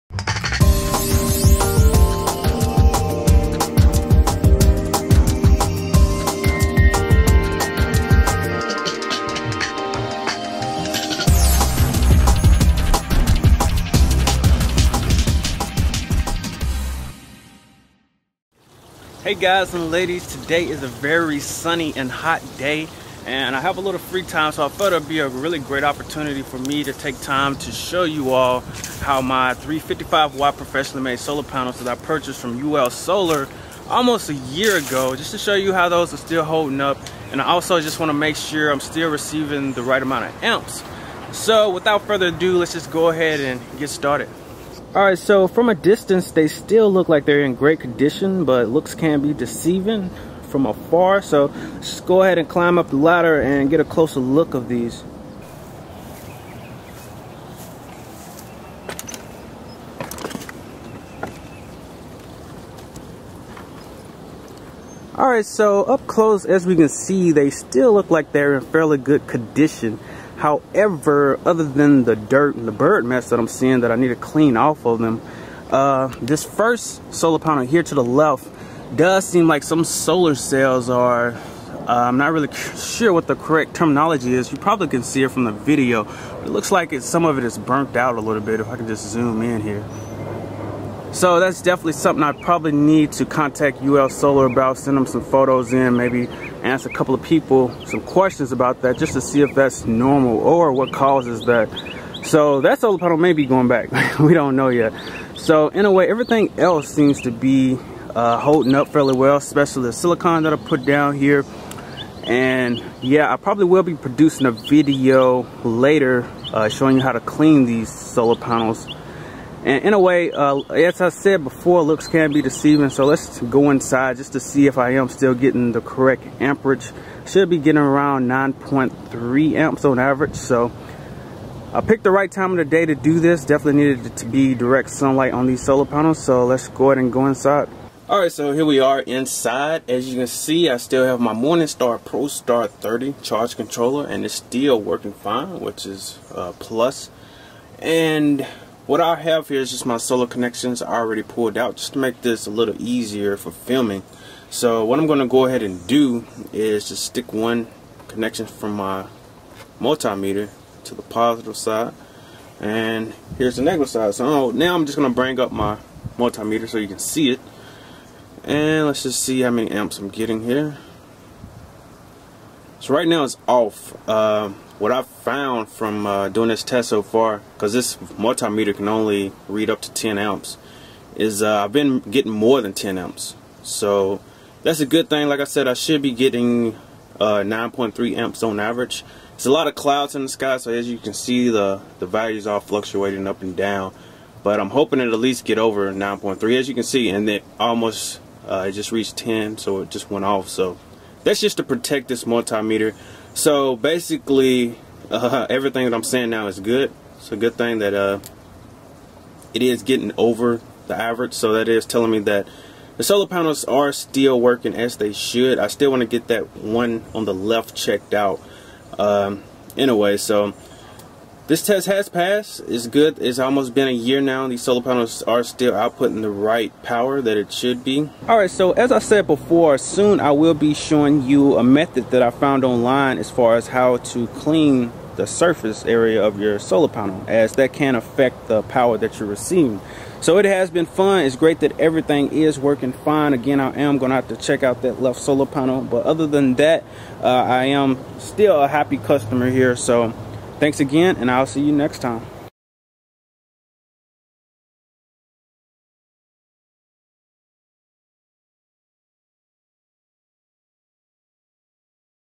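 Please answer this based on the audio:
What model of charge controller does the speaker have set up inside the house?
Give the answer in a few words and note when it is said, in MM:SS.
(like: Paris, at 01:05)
Morningstar ProStar 30, at 02:21.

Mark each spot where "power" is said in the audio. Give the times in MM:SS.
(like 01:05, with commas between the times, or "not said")
03:46, 03:58.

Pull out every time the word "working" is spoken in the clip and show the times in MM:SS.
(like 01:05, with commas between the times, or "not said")
02:24, 03:34, 04:02.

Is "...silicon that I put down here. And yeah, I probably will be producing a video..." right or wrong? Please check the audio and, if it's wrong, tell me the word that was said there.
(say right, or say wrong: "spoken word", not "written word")
right.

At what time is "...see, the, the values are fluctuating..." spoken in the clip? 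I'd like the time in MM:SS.
03:11.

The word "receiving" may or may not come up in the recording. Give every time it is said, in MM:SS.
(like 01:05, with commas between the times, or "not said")
00:39, 03:59.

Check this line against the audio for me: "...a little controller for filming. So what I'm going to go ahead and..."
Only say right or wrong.
wrong.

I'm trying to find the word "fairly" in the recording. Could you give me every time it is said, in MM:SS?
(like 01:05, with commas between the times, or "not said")
01:08, 01:48.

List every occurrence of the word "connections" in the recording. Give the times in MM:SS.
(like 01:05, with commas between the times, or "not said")
02:30, 02:38.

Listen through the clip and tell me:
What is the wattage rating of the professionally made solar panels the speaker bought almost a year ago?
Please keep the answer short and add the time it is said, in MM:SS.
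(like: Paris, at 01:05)
355 watt, at 00:29.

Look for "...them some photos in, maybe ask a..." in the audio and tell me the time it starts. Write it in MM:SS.
01:34.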